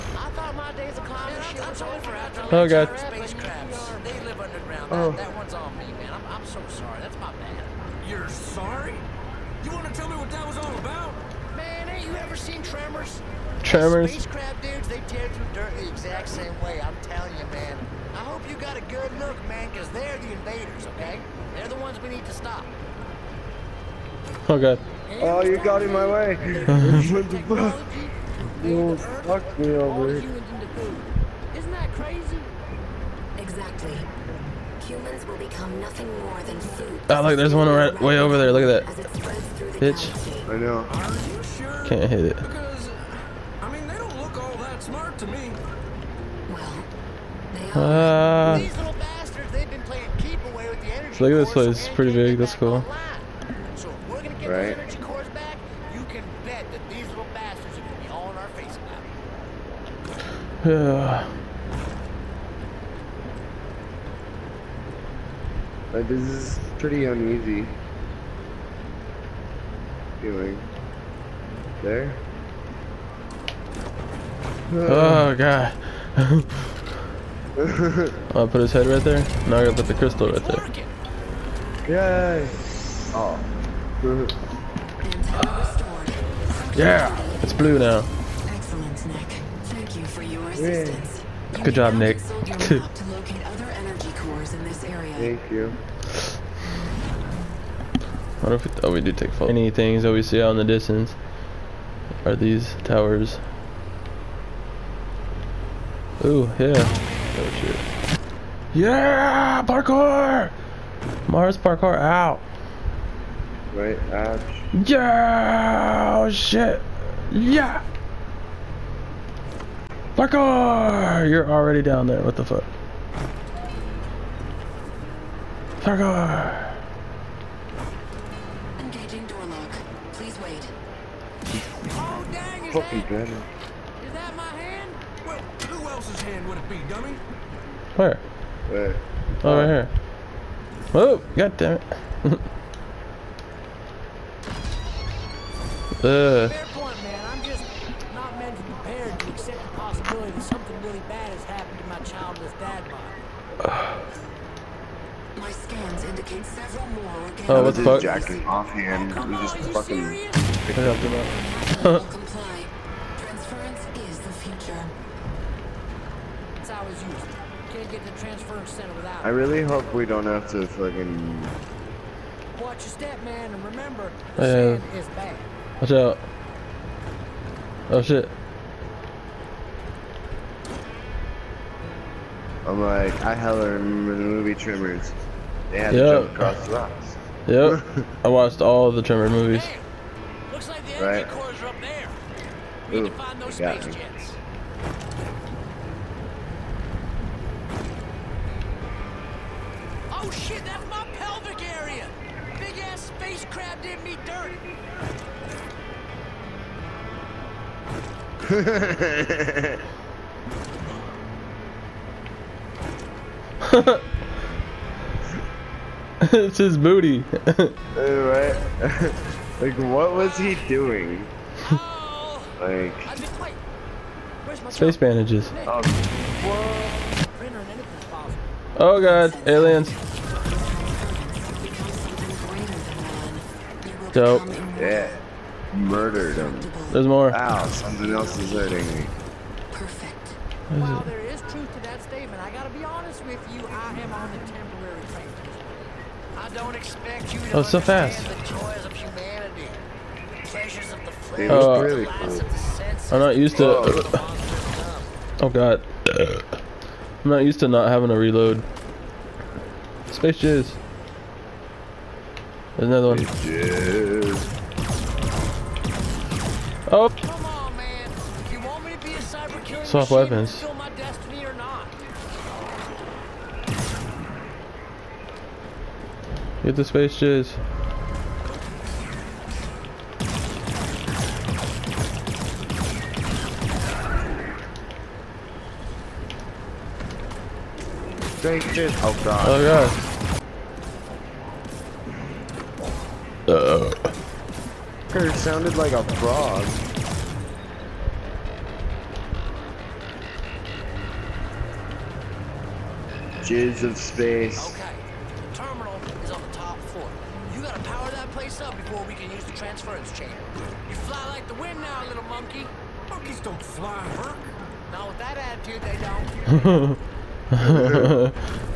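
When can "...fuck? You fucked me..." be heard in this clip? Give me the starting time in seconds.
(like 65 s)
27 s.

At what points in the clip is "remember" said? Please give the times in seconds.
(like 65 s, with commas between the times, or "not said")
173 s, 183 s.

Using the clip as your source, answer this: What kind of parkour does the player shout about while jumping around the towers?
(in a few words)
Mars parkour.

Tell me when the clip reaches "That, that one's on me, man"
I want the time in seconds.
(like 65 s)
5 s.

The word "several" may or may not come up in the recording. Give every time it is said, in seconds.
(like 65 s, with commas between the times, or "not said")
156 s.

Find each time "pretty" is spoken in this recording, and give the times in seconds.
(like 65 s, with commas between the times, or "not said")
51 s, 66 s.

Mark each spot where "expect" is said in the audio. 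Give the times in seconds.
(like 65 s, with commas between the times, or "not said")
246 s.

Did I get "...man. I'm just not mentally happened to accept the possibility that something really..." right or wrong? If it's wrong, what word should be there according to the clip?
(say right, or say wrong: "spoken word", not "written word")
wrong: "prepared", not "happened".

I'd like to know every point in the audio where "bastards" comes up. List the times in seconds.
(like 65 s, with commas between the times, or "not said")
48 s, 57 s.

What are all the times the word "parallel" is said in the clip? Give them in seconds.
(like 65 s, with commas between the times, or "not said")
not said.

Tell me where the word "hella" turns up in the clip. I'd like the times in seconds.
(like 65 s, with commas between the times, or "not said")
183 s.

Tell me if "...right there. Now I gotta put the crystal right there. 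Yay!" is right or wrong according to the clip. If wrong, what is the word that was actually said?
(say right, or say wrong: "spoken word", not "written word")
right.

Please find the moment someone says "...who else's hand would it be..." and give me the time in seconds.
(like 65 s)
135 s.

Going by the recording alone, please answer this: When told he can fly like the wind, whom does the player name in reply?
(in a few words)
Hurk.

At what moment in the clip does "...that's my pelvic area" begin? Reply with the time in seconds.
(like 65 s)
200 s.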